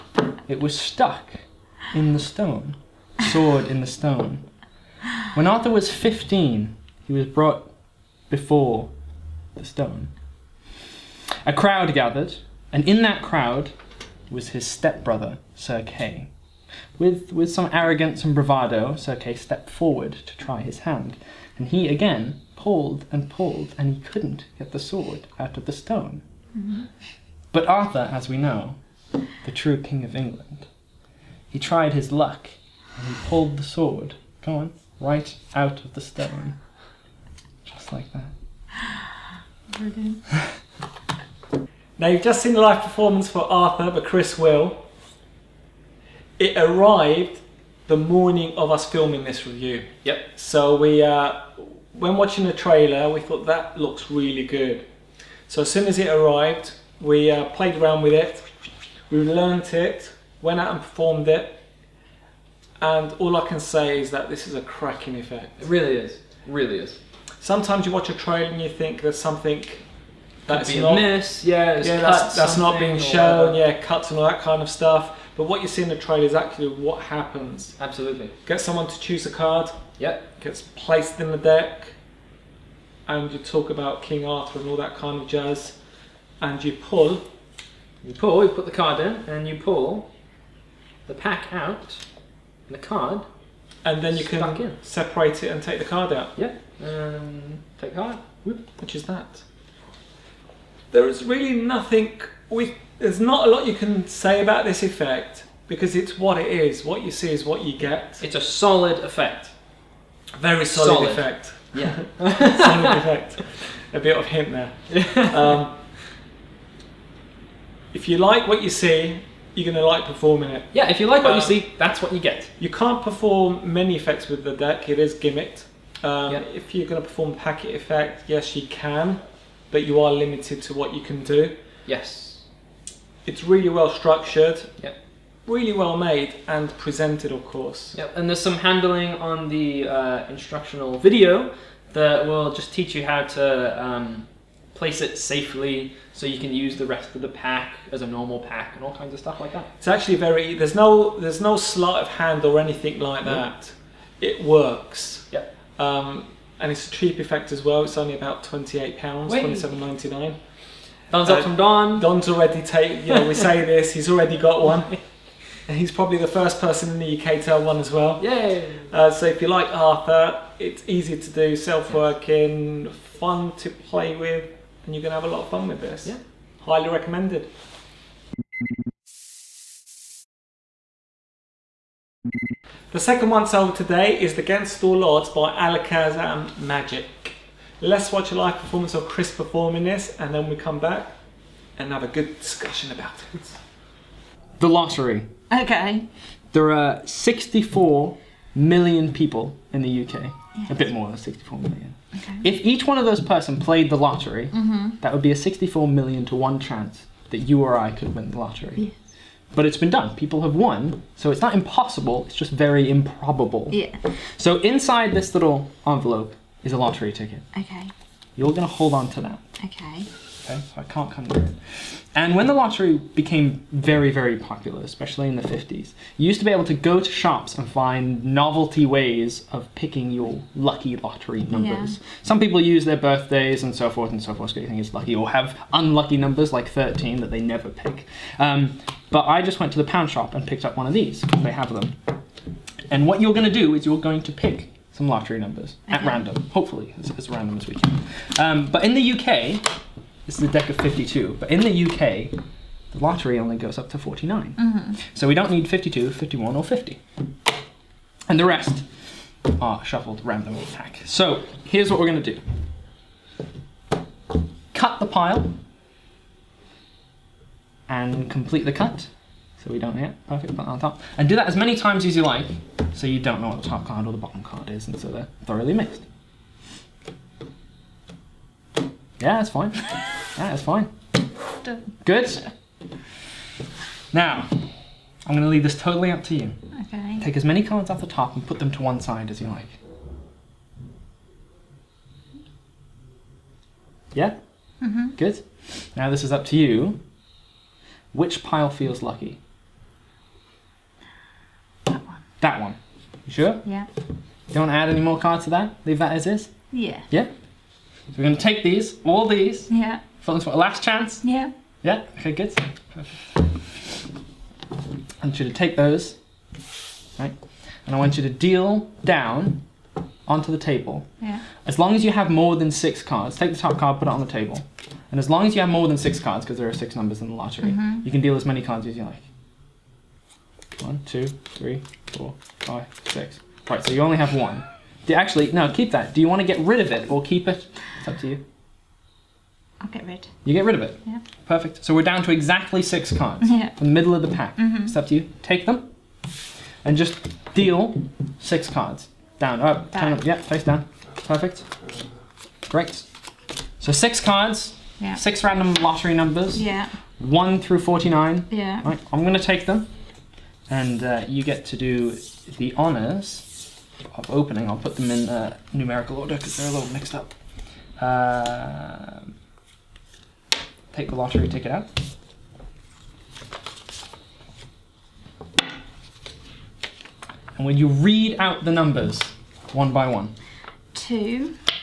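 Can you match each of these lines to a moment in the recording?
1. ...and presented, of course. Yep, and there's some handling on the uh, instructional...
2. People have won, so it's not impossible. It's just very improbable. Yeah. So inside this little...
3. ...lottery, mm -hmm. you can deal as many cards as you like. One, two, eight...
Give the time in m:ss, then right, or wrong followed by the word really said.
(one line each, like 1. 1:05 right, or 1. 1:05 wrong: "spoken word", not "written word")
1. 2:16 right
2. 3:30 right
3. 5:27 wrong: "three", not "eight".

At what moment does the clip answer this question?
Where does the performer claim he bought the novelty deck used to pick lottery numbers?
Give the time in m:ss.
3:59.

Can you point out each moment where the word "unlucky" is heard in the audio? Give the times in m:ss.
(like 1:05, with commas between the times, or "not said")
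3:55.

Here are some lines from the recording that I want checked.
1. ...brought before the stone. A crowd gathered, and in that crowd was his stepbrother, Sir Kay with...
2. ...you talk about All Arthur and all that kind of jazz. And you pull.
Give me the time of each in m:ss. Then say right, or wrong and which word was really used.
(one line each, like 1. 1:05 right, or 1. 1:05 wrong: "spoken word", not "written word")
1. 0:07 right
2. 1:23 wrong: "King", not "All".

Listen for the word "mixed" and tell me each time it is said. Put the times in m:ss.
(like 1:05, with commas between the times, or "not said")
4:35, 6:06.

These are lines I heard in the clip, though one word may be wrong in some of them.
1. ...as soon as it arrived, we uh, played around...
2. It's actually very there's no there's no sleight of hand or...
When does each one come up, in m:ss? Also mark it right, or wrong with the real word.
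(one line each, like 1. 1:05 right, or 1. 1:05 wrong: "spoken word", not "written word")
1. 0:55 right
2. 2:29 right.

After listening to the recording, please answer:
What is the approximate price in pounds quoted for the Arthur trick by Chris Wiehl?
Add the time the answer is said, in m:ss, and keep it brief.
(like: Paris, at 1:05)
£27.99, at 2:39.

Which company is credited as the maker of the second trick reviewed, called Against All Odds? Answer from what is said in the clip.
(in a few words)
Alakazam Magic.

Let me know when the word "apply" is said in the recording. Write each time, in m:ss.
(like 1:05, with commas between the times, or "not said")
not said.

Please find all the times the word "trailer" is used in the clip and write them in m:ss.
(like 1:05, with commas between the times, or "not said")
0:52, 1:08, 1:15.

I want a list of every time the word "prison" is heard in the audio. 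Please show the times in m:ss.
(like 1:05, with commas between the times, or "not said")
not said.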